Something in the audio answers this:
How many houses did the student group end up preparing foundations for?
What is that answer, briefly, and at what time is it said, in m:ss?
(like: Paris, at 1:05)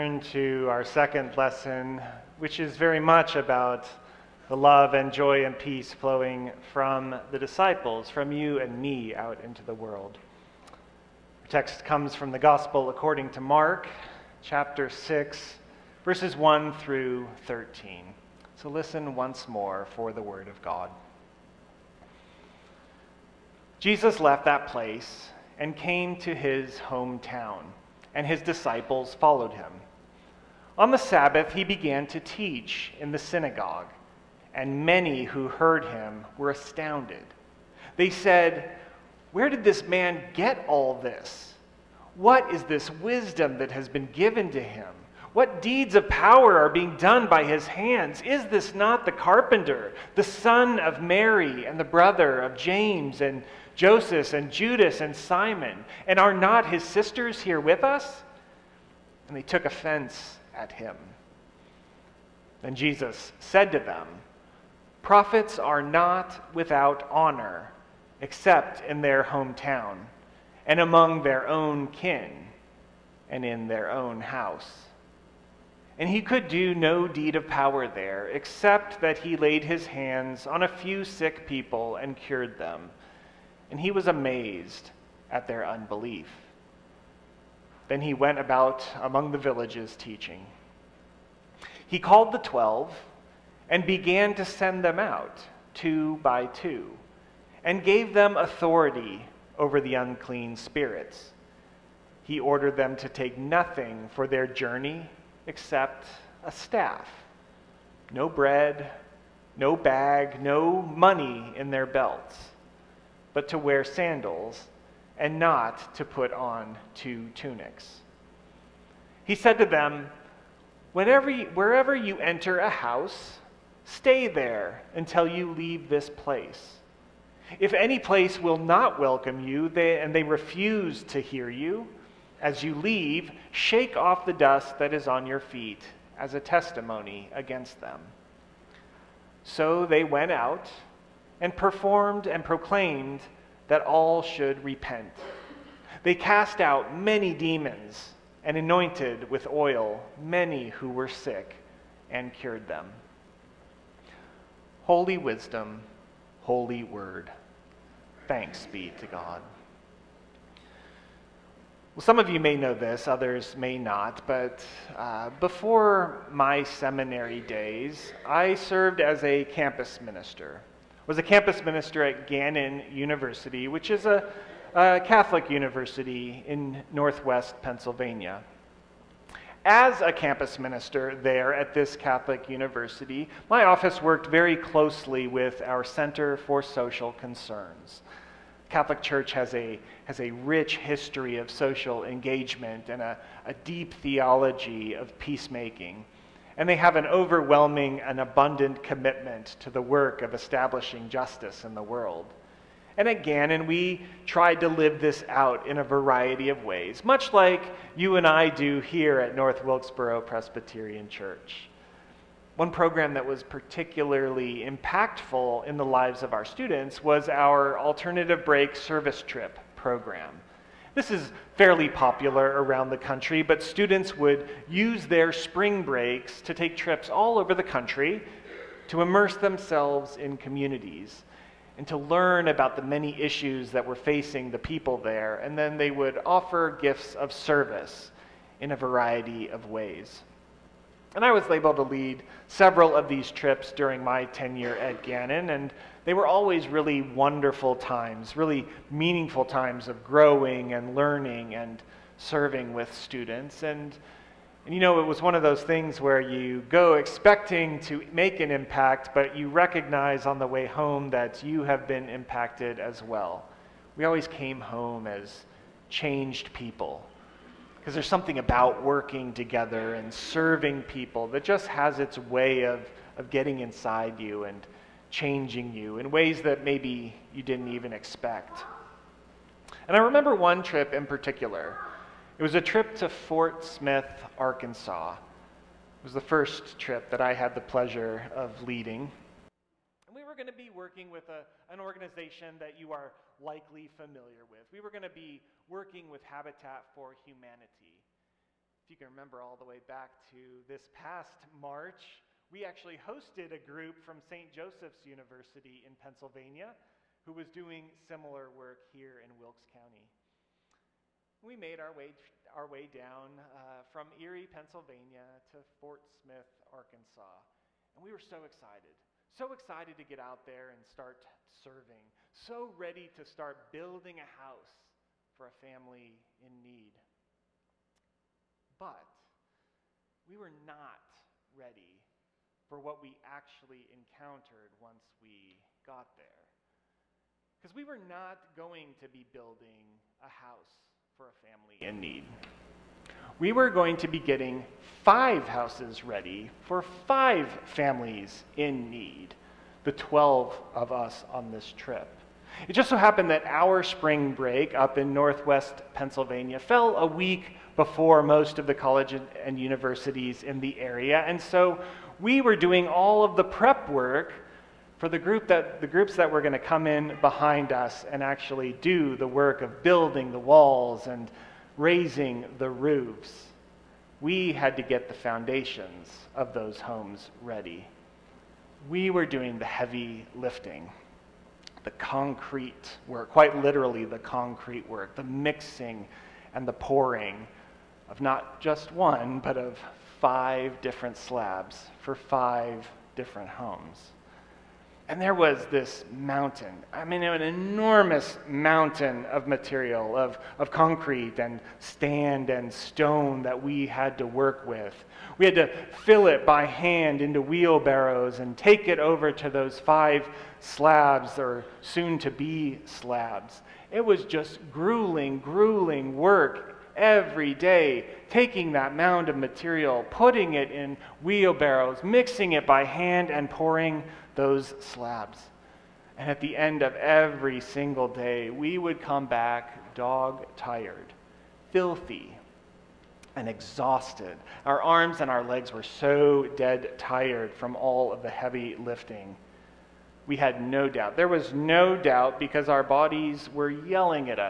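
5, at 5:45.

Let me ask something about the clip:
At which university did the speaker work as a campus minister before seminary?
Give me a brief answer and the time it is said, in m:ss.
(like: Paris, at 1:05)
Gannon University, at 2:52.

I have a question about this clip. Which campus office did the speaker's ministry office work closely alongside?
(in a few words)
Center for Social Concerns.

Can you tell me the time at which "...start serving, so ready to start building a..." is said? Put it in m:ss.
5:20.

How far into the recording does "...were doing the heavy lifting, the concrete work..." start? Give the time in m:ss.
6:19.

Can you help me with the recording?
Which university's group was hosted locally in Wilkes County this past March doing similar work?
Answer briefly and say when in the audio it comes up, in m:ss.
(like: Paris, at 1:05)
St. Joseph's University, at 5:04.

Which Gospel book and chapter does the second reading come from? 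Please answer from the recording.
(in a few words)
Mark 6.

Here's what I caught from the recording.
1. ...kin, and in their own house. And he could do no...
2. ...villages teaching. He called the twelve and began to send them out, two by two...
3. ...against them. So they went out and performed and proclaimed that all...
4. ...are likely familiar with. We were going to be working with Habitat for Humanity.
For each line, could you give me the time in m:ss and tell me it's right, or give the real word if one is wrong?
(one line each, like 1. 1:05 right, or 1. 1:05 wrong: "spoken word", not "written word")
1. 1:11 right
2. 1:29 right
3. 2:17 right
4. 4:52 right.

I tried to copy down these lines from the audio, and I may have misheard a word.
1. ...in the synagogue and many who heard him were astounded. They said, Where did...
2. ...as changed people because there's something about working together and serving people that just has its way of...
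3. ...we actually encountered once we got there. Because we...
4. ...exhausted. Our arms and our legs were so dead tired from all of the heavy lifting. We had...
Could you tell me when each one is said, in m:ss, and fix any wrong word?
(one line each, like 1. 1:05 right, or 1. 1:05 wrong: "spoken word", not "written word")
1. 0:32 right
2. 4:25 right
3. 5:33 right
4. 7:13 right.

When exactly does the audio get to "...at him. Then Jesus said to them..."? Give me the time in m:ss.
1:00.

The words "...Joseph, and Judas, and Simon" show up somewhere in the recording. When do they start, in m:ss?
0:53.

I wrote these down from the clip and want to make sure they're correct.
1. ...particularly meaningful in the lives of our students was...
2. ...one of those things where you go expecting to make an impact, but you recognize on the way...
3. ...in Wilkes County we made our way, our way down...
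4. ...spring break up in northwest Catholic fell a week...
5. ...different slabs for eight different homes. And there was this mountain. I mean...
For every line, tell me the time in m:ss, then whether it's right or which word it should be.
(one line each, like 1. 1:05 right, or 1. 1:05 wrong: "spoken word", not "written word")
1. 3:33 wrong: "impactful", not "meaningful"
2. 4:15 right
3. 5:09 right
4. 5:53 wrong: "Pennsylvania", not "Catholic"
5. 6:30 wrong: "five", not "eight".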